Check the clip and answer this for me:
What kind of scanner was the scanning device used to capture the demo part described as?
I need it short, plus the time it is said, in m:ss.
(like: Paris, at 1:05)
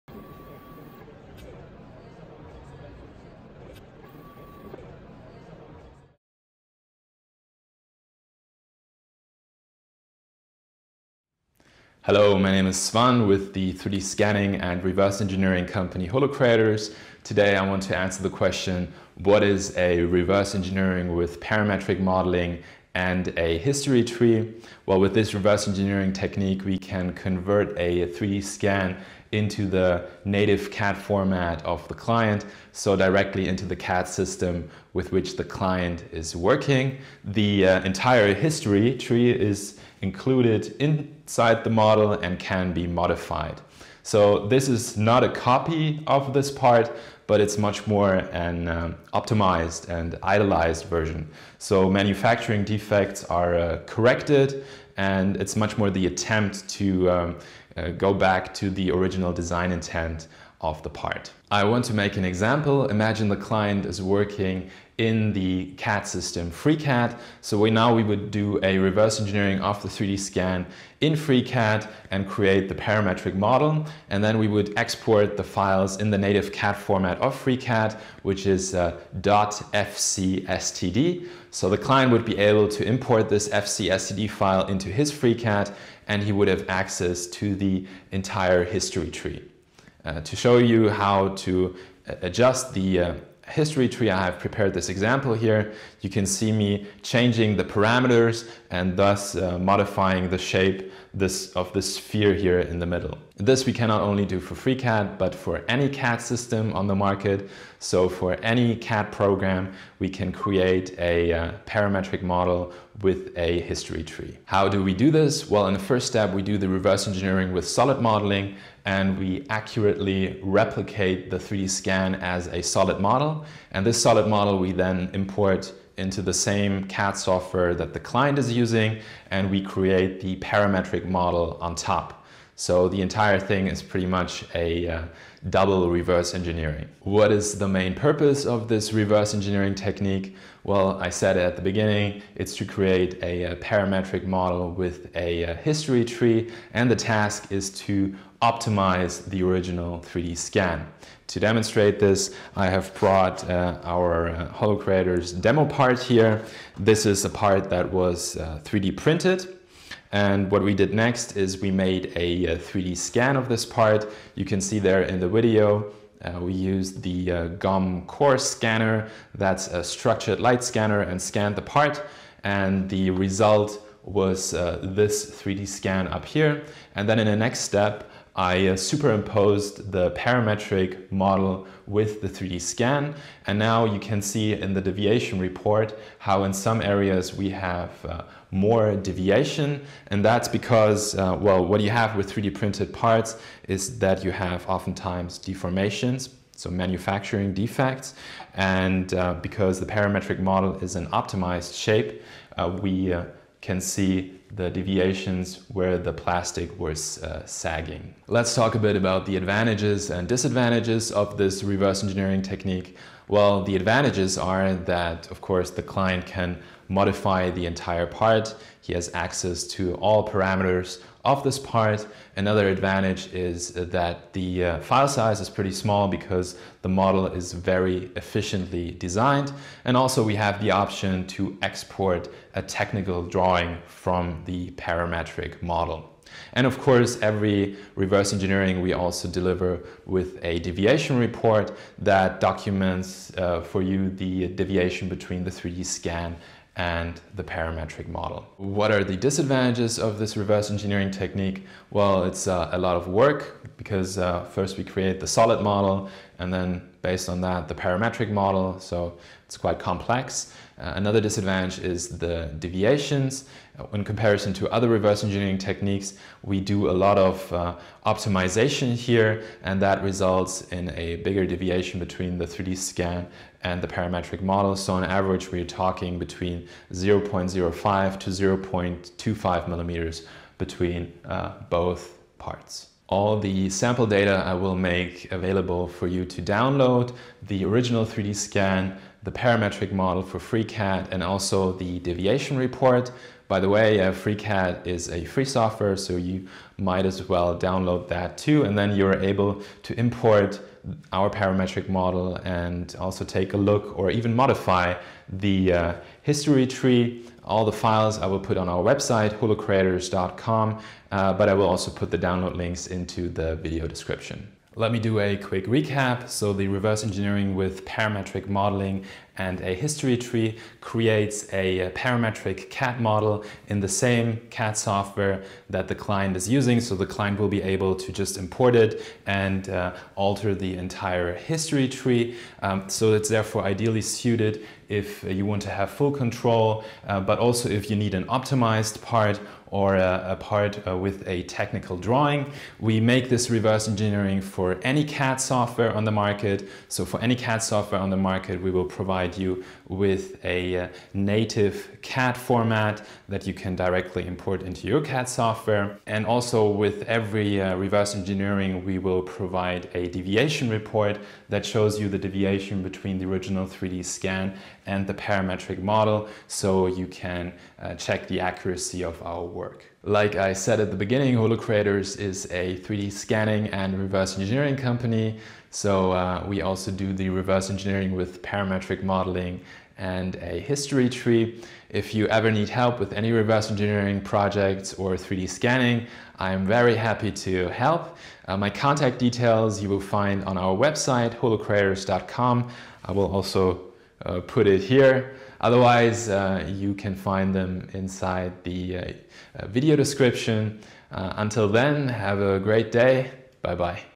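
Structured light scanner, at 2:49.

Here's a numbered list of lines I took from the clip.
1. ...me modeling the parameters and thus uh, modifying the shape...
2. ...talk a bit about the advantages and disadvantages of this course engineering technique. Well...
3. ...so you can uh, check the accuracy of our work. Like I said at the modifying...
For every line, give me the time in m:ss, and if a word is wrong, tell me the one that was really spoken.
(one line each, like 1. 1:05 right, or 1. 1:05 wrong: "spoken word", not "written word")
1. 1:36 wrong: "changing", not "modeling"
2. 3:28 wrong: "reverse", not "course"
3. 6:06 wrong: "beginning", not "modifying".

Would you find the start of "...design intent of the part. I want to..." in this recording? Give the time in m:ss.
0:59.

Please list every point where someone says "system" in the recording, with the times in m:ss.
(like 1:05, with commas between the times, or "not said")
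0:34, 1:06, 1:46.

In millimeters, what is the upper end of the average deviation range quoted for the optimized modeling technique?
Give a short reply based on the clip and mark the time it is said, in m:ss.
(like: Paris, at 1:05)
0.25 millimeters, at 4:38.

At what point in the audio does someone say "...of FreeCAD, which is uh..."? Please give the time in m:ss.
1:17.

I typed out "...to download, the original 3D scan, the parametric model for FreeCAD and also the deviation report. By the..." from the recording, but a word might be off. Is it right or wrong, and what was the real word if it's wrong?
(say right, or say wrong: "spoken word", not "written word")
right.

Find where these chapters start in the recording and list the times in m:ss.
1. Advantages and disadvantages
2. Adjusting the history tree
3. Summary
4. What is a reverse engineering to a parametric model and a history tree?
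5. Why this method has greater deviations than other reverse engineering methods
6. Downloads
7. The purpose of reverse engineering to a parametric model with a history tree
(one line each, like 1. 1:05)
1. 3:28
2. 1:29
3. 5:14
4. 0:18
5. 2:56
6. 4:42
7. 2:16.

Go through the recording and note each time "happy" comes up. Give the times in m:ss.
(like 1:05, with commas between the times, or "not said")
6:26.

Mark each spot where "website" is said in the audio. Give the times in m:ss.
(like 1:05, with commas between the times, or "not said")
5:08, 6:30.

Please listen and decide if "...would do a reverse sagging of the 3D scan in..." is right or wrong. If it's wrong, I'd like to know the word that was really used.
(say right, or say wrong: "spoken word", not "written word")
wrong: "engineering", not "sagging".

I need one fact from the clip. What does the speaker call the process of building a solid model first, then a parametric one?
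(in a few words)
Double reverse engineering.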